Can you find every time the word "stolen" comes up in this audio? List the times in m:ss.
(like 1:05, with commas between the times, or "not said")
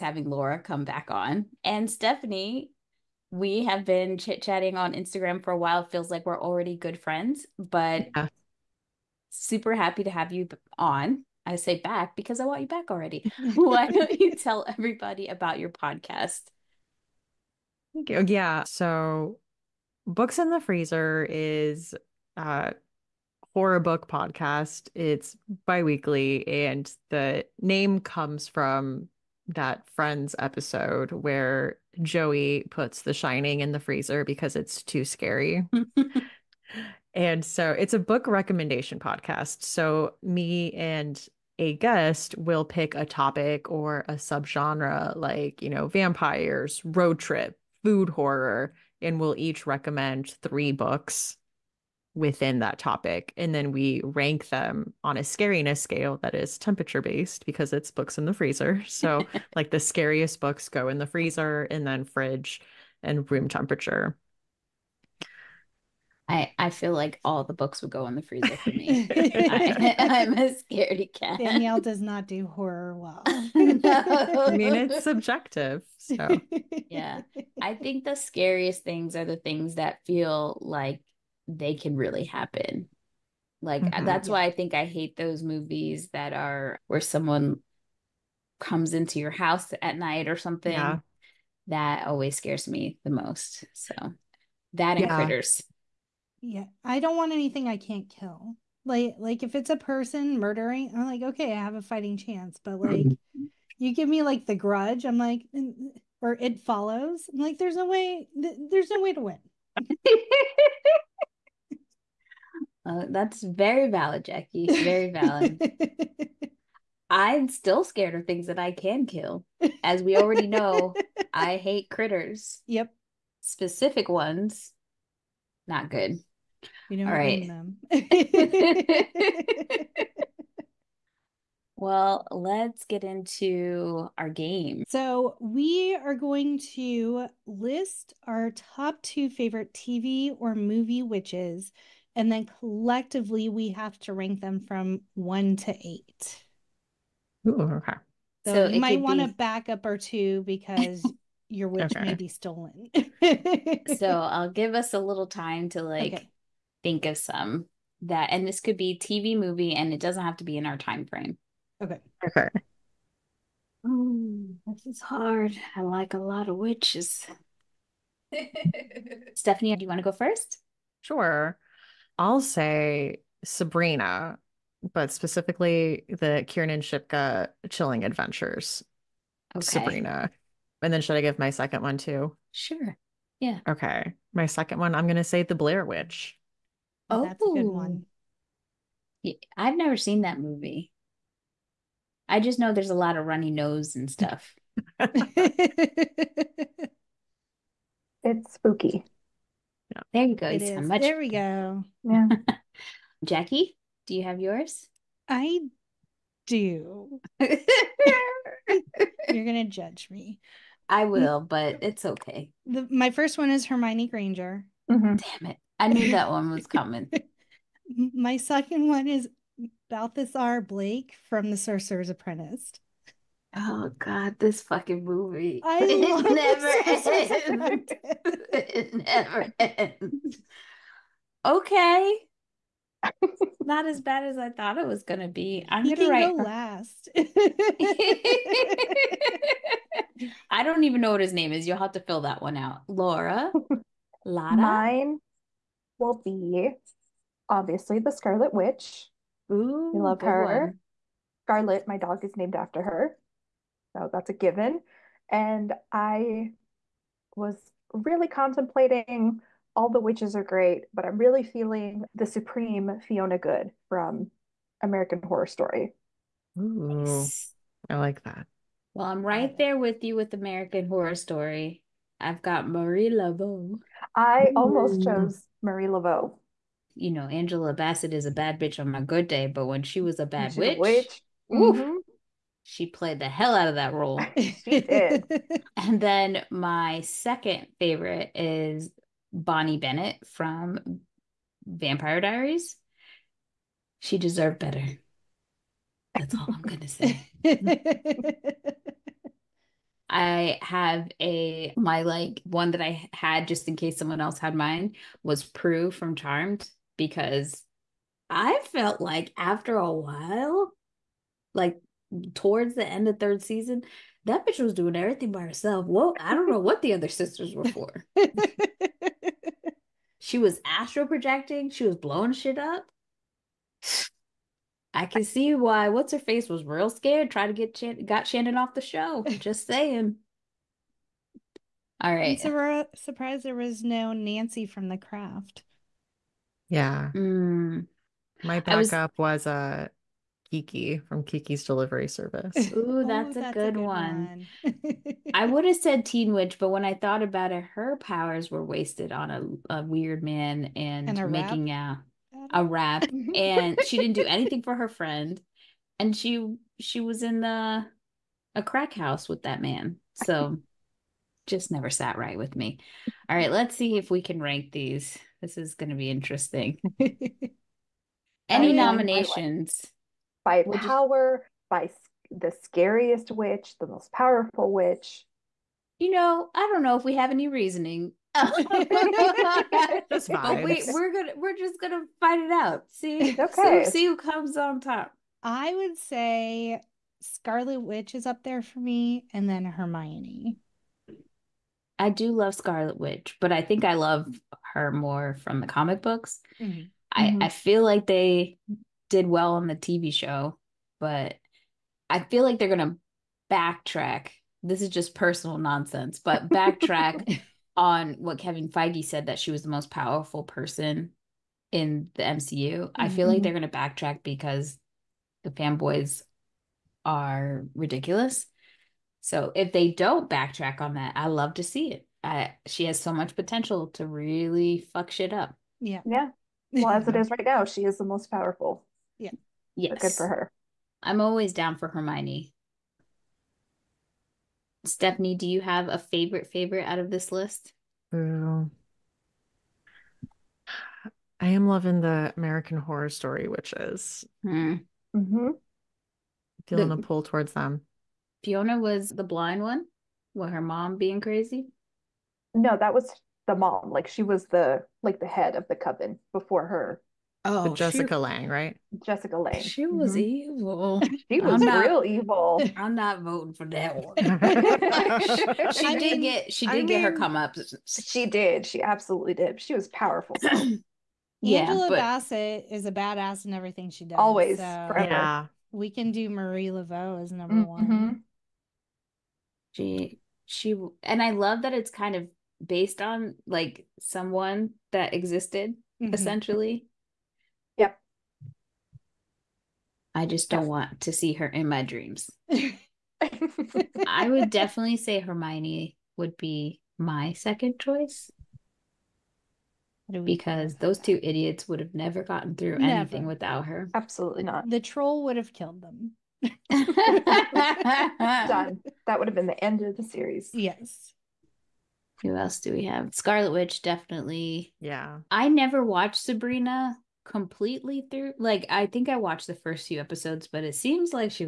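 2:32.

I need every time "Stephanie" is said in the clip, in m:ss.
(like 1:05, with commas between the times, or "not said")
0:01, 2:49, 7:14.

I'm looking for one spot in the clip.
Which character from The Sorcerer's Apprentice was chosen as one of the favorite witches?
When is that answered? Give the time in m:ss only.
3:39.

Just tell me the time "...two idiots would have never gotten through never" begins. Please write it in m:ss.
8:20.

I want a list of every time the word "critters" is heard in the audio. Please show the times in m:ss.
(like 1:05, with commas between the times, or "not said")
1:35, 2:01.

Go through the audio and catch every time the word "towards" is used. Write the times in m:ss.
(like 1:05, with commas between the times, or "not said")
5:12, 7:27.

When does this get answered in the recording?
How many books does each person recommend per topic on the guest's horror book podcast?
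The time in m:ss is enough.
0:50.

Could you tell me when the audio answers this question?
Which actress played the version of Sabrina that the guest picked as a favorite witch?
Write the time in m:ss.
2:56.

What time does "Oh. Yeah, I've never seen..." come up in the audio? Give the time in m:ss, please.
3:08.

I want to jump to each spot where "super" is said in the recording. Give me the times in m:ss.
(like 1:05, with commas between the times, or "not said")
0:09.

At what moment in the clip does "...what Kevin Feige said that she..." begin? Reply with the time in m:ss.
6:48.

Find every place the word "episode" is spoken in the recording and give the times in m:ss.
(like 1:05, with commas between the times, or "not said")
0:30, 8:39.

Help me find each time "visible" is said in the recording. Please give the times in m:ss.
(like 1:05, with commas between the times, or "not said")
not said.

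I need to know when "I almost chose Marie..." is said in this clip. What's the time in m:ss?
4:34.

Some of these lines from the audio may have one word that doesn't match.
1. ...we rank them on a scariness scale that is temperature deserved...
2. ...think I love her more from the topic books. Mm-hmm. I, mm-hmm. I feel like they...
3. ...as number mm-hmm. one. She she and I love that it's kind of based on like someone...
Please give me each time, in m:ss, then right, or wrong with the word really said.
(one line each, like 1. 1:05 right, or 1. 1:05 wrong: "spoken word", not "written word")
1. 0:53 wrong: "based", not "deserved"
2. 6:33 wrong: "comic", not "topic"
3. 7:57 right.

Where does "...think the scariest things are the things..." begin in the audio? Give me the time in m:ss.
1:17.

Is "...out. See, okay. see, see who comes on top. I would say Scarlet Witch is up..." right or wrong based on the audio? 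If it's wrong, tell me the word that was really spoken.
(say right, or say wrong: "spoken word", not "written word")
right.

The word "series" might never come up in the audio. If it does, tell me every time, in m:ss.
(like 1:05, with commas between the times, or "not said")
8:30.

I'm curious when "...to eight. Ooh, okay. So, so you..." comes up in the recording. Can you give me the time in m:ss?
2:25.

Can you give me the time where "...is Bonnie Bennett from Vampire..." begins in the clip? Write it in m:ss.
4:48.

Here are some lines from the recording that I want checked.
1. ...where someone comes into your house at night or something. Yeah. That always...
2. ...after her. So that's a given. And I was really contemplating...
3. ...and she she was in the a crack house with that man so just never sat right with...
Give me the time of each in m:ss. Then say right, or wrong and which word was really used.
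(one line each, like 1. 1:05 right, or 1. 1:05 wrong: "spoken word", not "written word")
1. 1:26 right
2. 4:12 right
3. 5:55 right.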